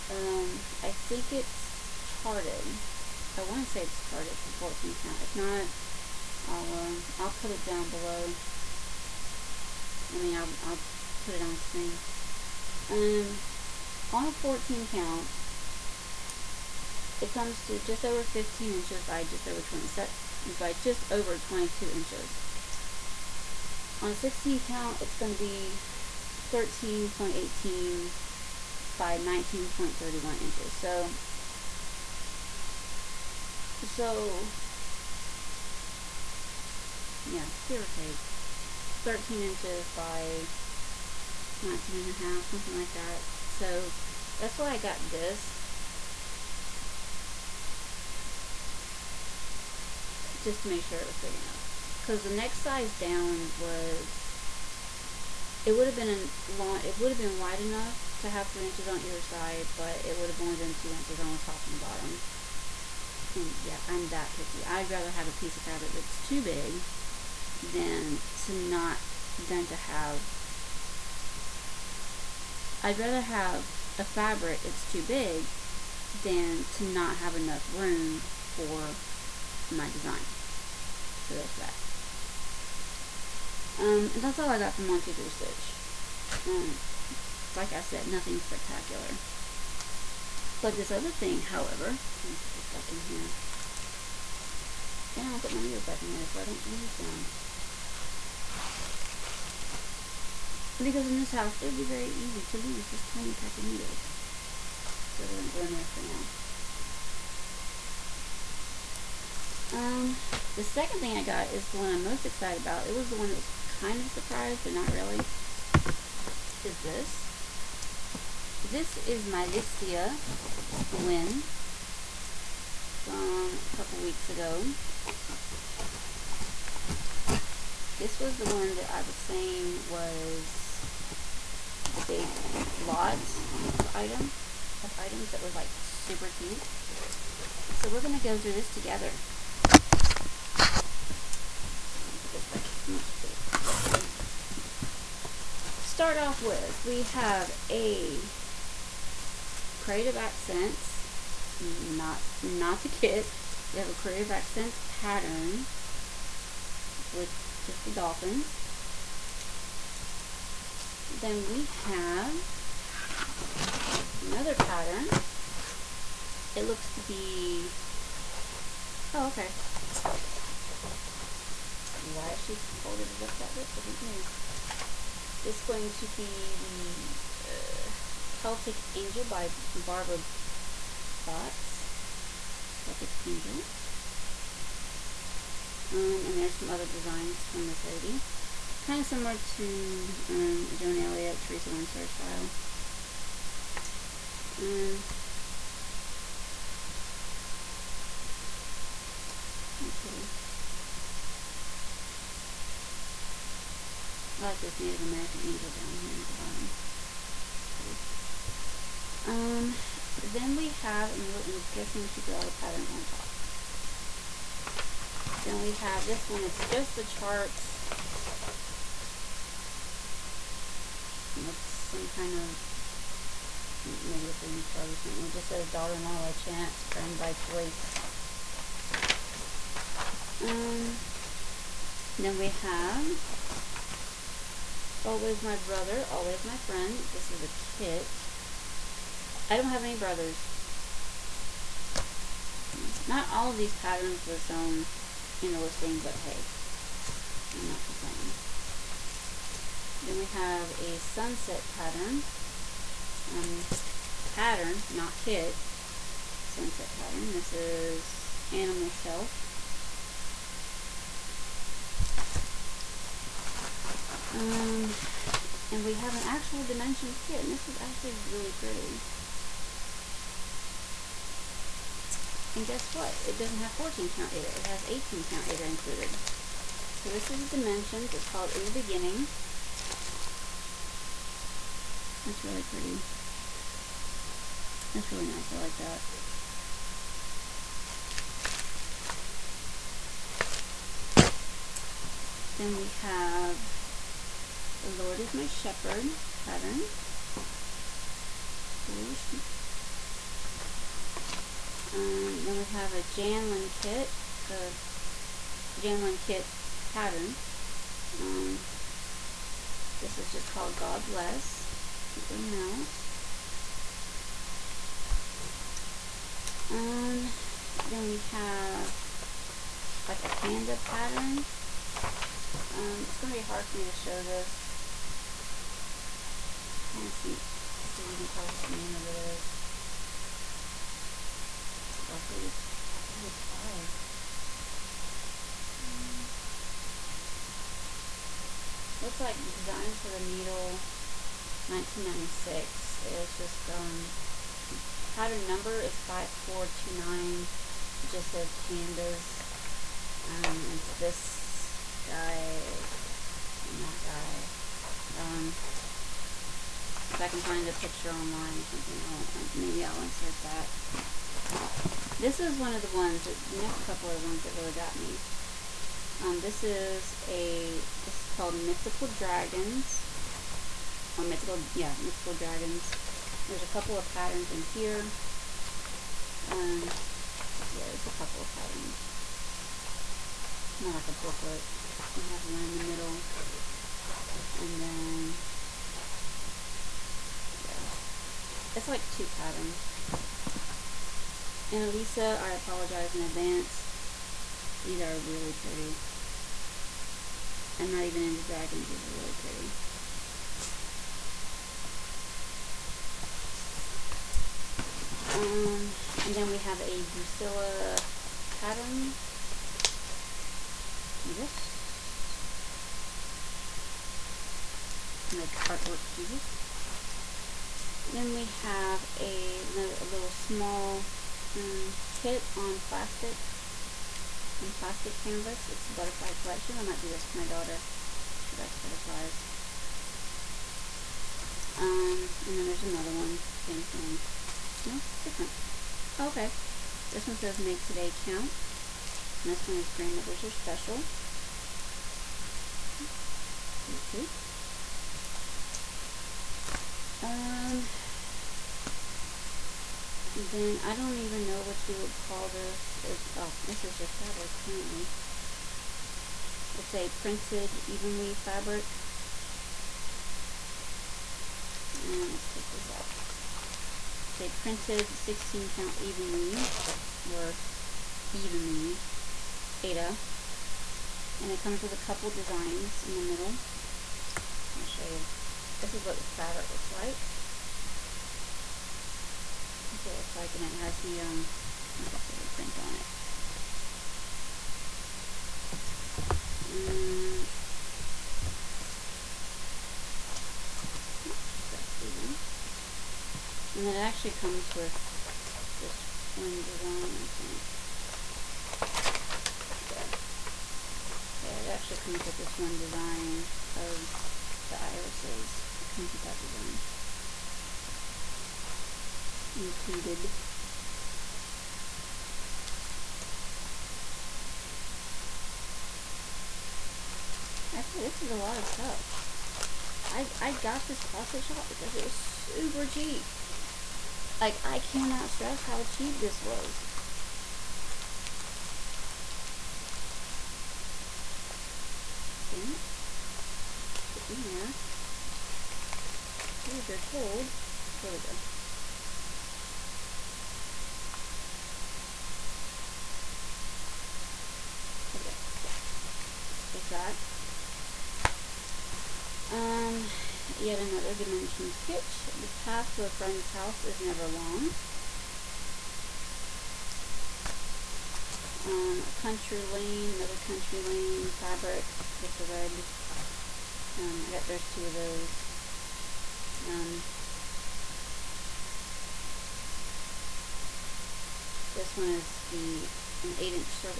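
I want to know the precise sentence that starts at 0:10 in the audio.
I mean, I'll, I'll put it on screen.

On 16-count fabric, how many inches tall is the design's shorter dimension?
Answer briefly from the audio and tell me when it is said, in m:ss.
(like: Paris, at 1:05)
13.18, at 0:26.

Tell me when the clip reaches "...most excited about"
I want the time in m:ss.
1:52.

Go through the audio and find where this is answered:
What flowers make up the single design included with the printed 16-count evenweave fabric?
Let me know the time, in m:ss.
8:24.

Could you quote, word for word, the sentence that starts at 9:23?
Um, I got there's two of those.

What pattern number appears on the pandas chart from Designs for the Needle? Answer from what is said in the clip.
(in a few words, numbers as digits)
5429.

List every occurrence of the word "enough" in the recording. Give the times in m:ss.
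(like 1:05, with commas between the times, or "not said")
0:51, 0:57, 1:17.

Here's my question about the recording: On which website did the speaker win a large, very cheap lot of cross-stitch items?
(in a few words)
Listia.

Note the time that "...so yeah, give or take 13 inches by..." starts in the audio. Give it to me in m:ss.
0:33.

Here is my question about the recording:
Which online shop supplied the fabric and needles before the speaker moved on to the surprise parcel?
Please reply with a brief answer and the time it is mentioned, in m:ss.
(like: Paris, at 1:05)
123 Stitch, at 1:24.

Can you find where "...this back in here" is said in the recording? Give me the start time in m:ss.
1:32.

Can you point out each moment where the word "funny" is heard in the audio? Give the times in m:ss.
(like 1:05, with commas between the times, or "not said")
not said.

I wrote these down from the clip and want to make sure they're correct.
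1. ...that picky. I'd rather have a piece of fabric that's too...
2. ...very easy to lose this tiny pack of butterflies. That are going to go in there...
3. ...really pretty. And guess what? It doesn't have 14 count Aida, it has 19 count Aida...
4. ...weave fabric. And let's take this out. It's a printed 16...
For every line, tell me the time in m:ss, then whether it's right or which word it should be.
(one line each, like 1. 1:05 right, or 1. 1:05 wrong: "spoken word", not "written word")
1. 1:04 right
2. 1:41 wrong: "needles", not "butterflies"
3. 4:28 wrong: "18", not "19"
4. 7:38 right.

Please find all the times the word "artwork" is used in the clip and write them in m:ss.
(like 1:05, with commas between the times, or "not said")
6:55.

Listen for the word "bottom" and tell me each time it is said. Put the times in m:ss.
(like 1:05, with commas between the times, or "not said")
1:01, 3:26.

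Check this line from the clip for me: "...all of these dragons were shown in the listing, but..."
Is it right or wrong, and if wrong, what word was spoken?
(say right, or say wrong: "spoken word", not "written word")
wrong: "patterns", not "dragons".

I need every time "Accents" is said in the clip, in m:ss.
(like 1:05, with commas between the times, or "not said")
2:30, 2:34.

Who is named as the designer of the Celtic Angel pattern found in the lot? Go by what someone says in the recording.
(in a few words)
Barbara Baatz.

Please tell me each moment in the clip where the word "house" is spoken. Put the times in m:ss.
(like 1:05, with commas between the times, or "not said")
1:41, 9:13.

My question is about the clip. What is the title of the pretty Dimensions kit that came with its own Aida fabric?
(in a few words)
In the Beginning.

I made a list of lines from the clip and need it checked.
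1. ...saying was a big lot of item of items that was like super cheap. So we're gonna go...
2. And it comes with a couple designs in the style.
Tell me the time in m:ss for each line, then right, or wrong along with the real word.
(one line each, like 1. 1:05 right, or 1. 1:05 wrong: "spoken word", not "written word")
1. 2:09 right
2. 7:51 wrong: "middle", not "style".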